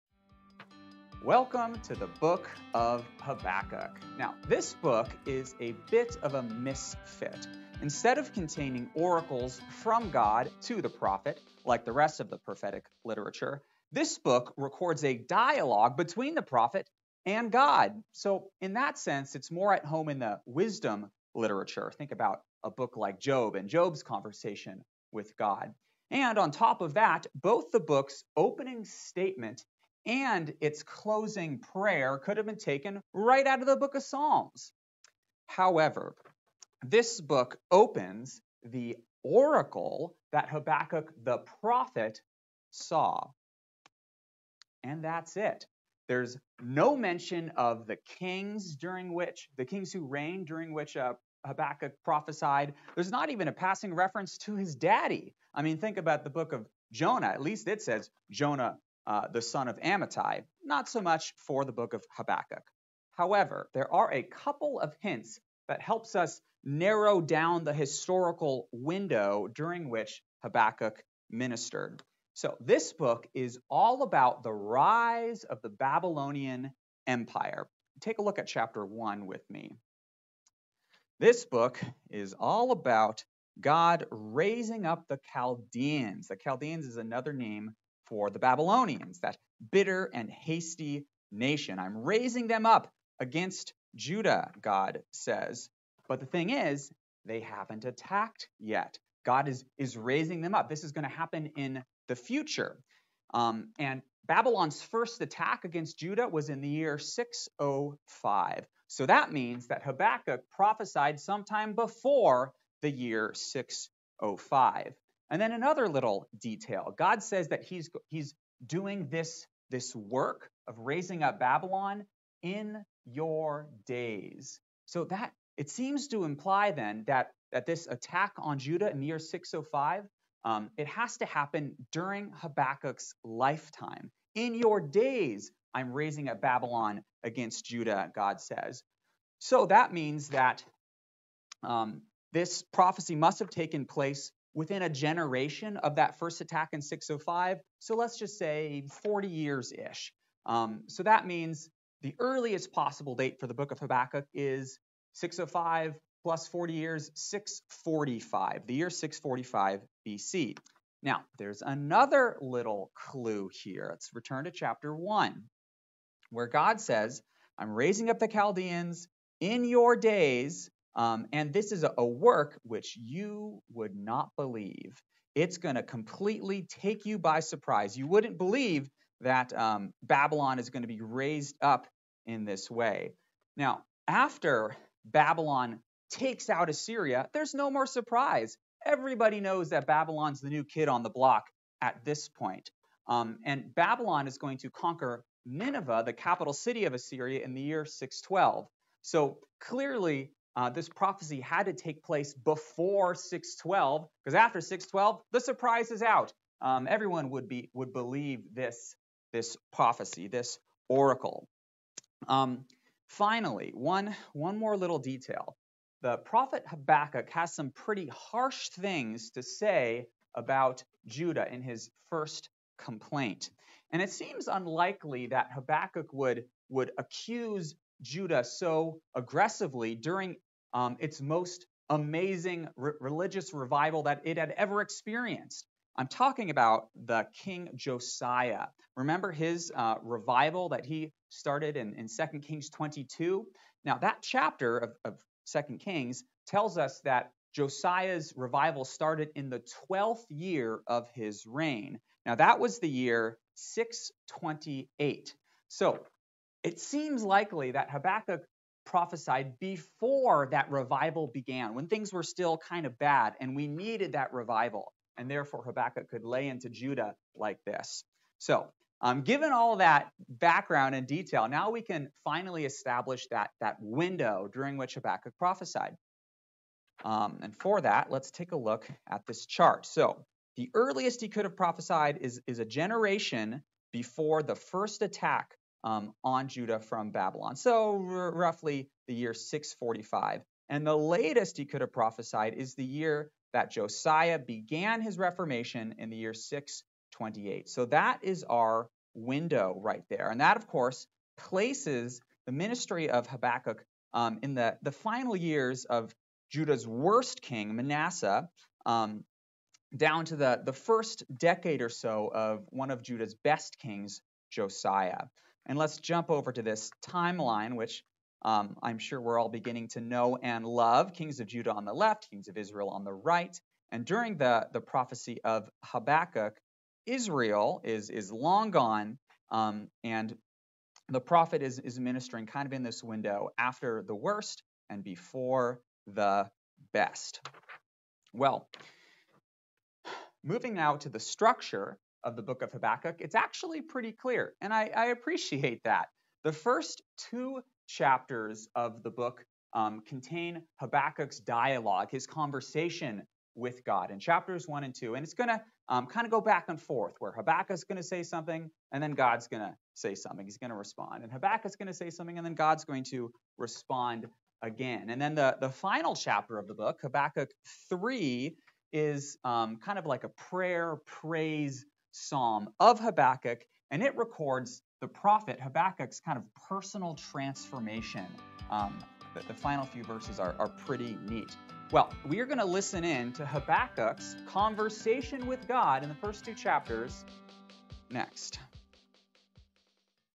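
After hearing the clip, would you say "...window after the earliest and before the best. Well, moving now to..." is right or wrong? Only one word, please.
wrong.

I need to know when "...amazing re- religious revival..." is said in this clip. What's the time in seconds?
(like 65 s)
231 s.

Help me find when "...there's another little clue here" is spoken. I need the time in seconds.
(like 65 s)
161 s.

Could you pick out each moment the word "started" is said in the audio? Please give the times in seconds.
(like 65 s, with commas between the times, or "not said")
241 s, 248 s.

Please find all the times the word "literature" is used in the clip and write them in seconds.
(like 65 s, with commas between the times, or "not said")
13 s, 21 s.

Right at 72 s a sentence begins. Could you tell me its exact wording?
So this book is all about the rise of the Babylonian Empire.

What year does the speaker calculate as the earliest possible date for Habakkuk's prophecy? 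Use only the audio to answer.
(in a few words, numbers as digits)
645 BC.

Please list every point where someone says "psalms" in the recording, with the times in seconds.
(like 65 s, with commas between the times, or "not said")
34 s, 372 s.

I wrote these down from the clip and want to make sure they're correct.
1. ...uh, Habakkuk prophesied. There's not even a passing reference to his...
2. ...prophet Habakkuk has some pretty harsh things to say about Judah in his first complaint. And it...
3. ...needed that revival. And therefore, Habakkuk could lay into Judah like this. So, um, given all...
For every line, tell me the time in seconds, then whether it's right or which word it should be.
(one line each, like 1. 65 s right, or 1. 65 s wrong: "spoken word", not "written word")
1. 50 s right
2. 216 s right
3. 263 s right.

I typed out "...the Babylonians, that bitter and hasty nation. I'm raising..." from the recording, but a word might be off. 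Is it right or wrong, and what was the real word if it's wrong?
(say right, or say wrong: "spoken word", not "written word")
right.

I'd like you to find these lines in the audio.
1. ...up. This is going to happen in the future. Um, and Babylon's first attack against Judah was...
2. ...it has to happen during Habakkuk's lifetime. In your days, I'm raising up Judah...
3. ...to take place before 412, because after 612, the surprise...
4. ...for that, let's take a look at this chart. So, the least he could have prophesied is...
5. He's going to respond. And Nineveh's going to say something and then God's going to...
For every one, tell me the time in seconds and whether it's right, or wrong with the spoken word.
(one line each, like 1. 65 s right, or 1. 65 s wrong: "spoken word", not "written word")
1. 100 s right
2. 130 s wrong: "Babylon", not "Judah"
3. 201 s wrong: "612", not "412"
4. 277 s wrong: "earliest", not "least"
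5. 360 s wrong: "Habakkuk", not "Nineveh".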